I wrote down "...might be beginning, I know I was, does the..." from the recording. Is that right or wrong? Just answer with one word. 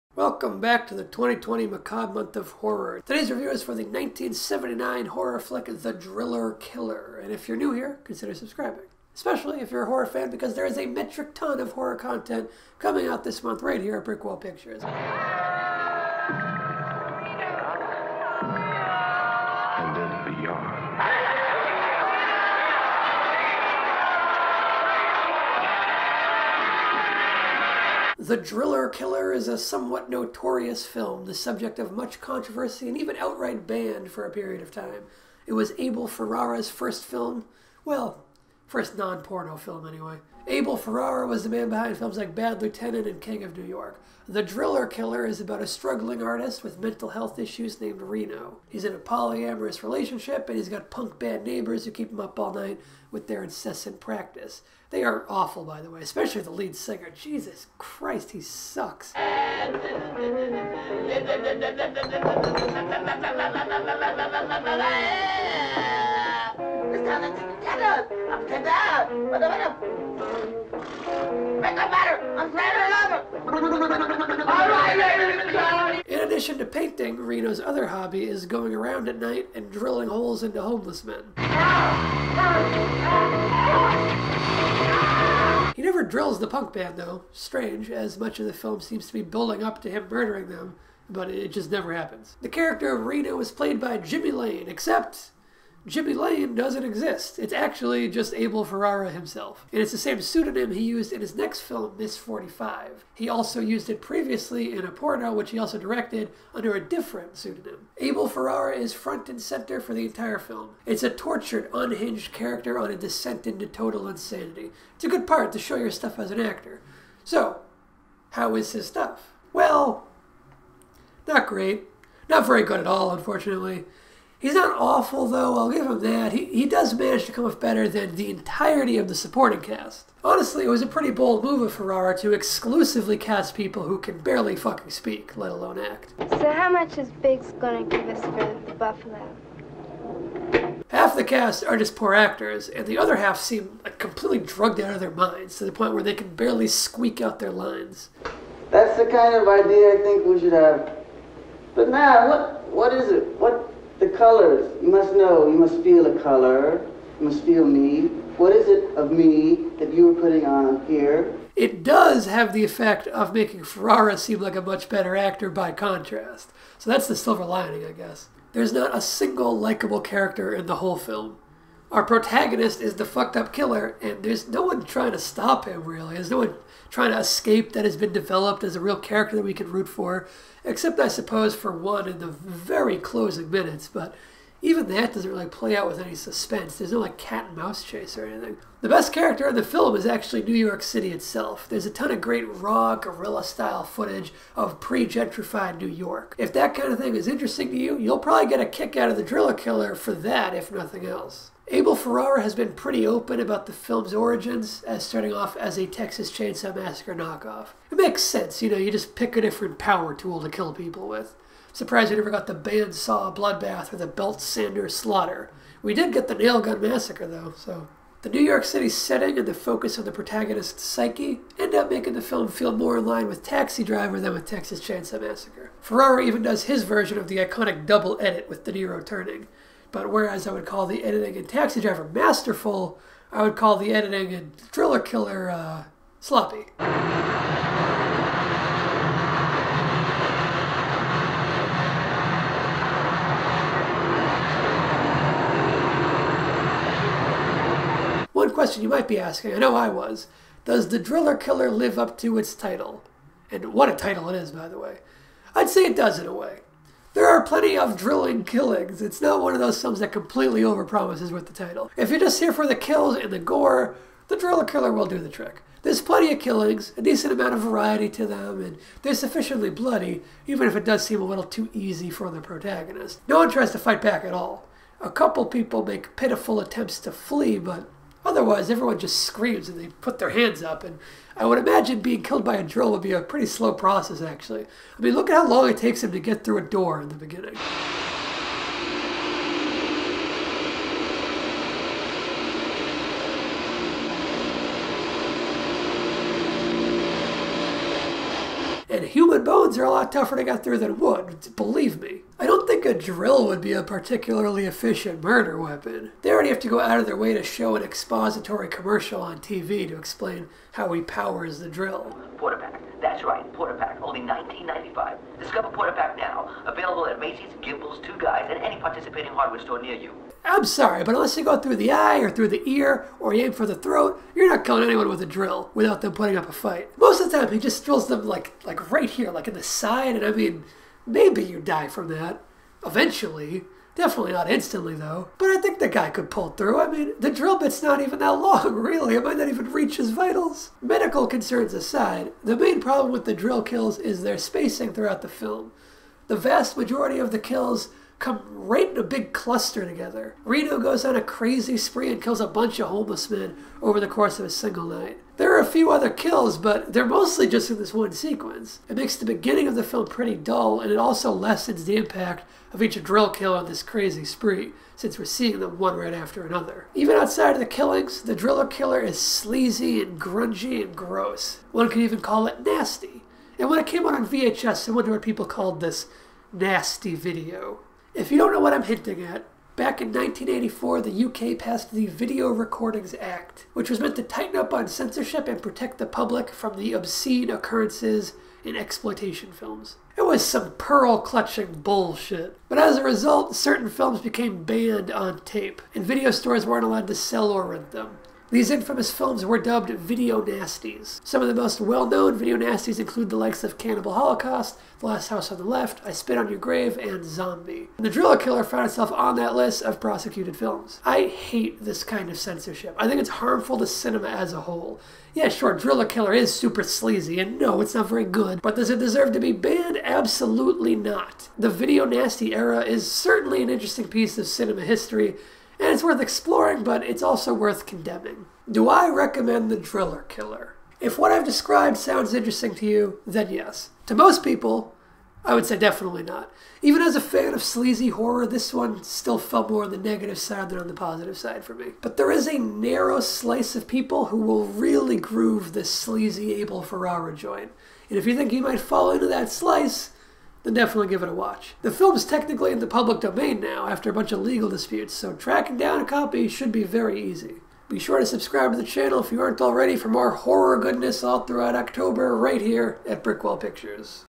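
wrong.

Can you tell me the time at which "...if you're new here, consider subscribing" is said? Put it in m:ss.
0:07.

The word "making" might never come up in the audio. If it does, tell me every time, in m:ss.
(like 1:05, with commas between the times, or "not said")
2:43, 3:41.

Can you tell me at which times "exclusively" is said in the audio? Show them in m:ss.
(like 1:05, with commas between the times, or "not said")
2:12.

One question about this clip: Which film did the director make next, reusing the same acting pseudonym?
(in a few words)
Miss 45.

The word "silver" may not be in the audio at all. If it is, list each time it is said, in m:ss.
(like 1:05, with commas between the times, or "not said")
2:47.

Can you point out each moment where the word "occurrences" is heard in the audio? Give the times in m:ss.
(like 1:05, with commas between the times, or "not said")
6:27.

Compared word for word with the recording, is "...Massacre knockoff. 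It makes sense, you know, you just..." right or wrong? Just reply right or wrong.
right.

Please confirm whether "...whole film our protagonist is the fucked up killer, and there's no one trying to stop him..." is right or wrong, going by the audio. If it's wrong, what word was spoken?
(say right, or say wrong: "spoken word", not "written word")
right.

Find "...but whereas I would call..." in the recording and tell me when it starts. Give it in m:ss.
3:49.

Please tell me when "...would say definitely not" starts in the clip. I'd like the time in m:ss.
7:15.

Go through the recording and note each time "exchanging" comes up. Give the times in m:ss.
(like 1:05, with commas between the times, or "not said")
not said.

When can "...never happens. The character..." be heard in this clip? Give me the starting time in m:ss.
1:31.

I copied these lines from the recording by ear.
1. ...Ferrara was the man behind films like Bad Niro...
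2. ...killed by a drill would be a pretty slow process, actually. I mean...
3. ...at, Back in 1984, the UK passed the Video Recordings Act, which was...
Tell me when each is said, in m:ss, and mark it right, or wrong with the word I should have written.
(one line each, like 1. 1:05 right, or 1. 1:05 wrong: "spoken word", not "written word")
1. 0:40 wrong: "Lieutenant", not "Niro"
2. 4:42 right
3. 6:19 right.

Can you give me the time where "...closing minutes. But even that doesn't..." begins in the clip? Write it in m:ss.
3:02.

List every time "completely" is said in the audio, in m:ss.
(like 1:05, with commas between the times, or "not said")
2:23, 4:20.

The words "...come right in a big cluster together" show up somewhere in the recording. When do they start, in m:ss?
5:48.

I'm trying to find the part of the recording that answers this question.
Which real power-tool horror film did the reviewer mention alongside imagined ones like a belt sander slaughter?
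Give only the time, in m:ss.
3:36.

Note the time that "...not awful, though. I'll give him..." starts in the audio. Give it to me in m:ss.
2:04.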